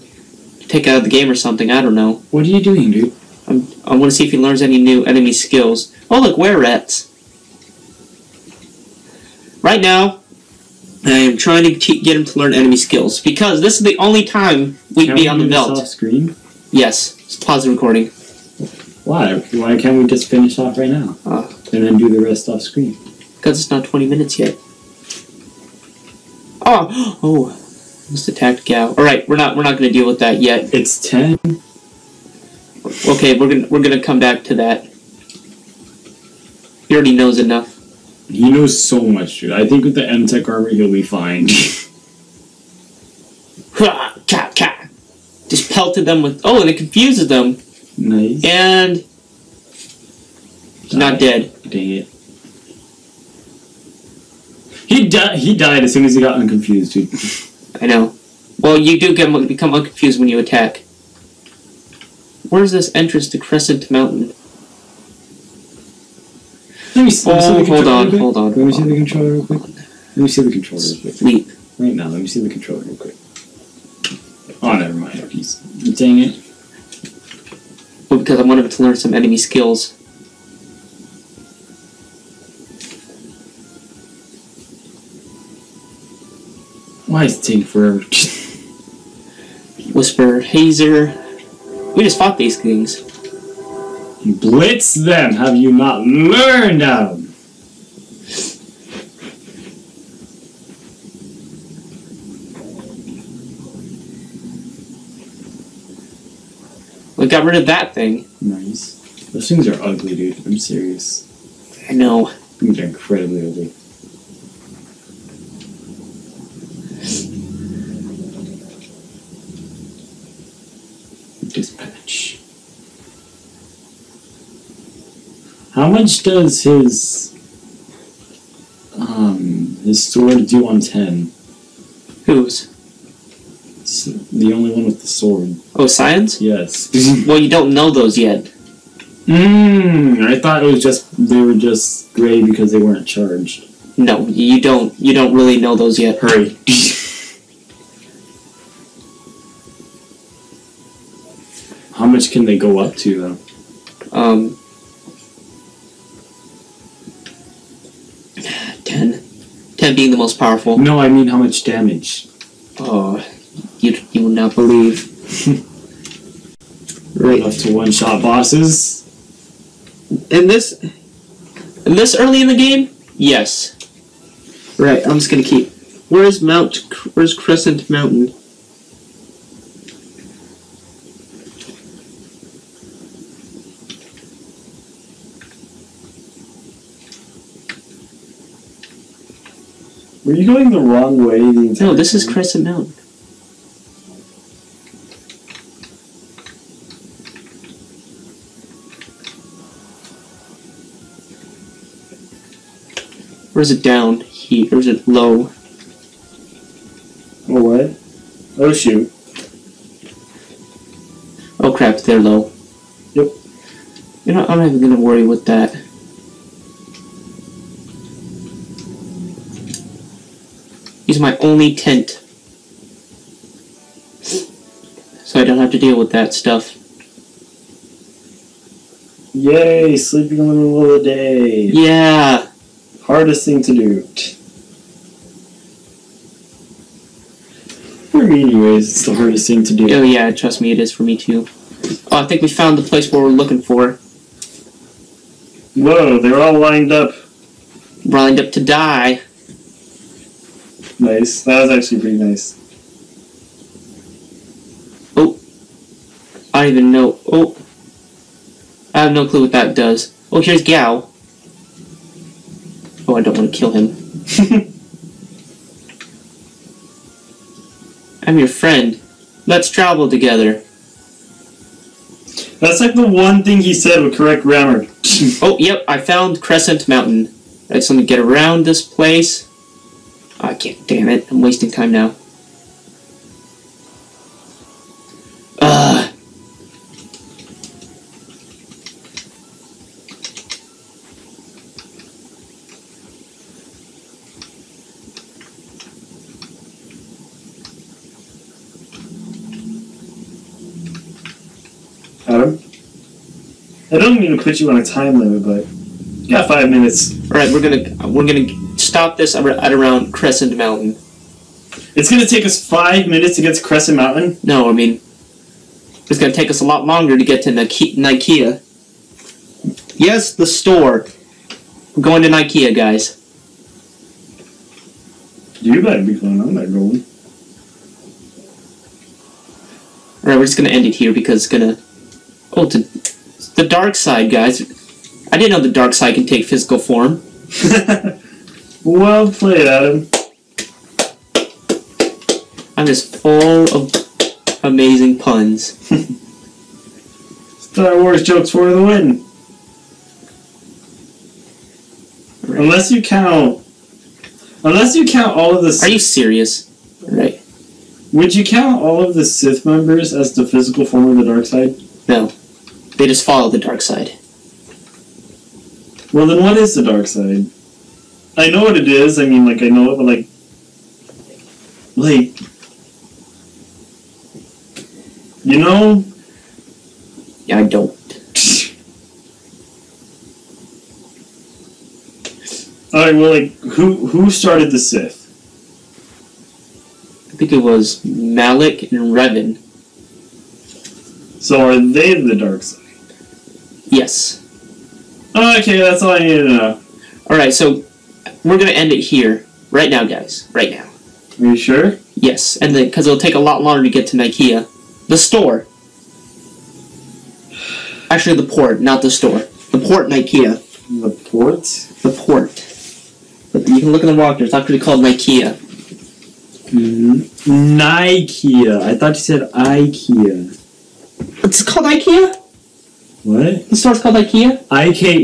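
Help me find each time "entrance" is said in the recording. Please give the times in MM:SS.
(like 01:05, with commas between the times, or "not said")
01:02.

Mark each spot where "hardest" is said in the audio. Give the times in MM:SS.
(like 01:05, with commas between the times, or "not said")
03:53, 03:59.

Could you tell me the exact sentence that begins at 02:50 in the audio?
In this, in this early in the game, yes.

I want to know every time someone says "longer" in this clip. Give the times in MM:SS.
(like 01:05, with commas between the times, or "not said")
05:16, 06:43.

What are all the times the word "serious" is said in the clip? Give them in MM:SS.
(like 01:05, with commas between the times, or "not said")
01:50, 05:55.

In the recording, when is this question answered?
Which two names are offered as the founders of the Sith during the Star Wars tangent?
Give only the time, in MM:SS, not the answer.
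06:28.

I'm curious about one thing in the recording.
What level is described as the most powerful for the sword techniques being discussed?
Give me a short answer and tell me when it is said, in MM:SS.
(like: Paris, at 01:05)
10, at 02:39.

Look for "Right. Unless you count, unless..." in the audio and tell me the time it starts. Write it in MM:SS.
05:52.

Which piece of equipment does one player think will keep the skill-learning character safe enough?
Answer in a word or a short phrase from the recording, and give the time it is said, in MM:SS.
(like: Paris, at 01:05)
M Tech armor, at 00:40.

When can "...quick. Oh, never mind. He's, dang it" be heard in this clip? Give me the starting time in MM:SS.
01:12.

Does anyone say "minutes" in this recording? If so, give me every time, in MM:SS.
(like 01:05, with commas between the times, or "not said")
00:24, 05:06, 05:13.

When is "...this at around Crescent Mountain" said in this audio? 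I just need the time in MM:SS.
05:09.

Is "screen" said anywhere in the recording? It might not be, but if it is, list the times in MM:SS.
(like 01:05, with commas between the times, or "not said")
00:15, 00:22.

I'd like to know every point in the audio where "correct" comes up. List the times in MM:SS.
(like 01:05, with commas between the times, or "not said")
04:34.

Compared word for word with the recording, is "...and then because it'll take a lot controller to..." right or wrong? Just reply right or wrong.
wrong.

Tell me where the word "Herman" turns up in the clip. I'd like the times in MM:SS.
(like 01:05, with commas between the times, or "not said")
not said.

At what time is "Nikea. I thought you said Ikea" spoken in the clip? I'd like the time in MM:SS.
06:57.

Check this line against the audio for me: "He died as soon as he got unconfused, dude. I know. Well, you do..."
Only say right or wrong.
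right.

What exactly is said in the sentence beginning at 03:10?
Were you going the wrong way the entire No, this time?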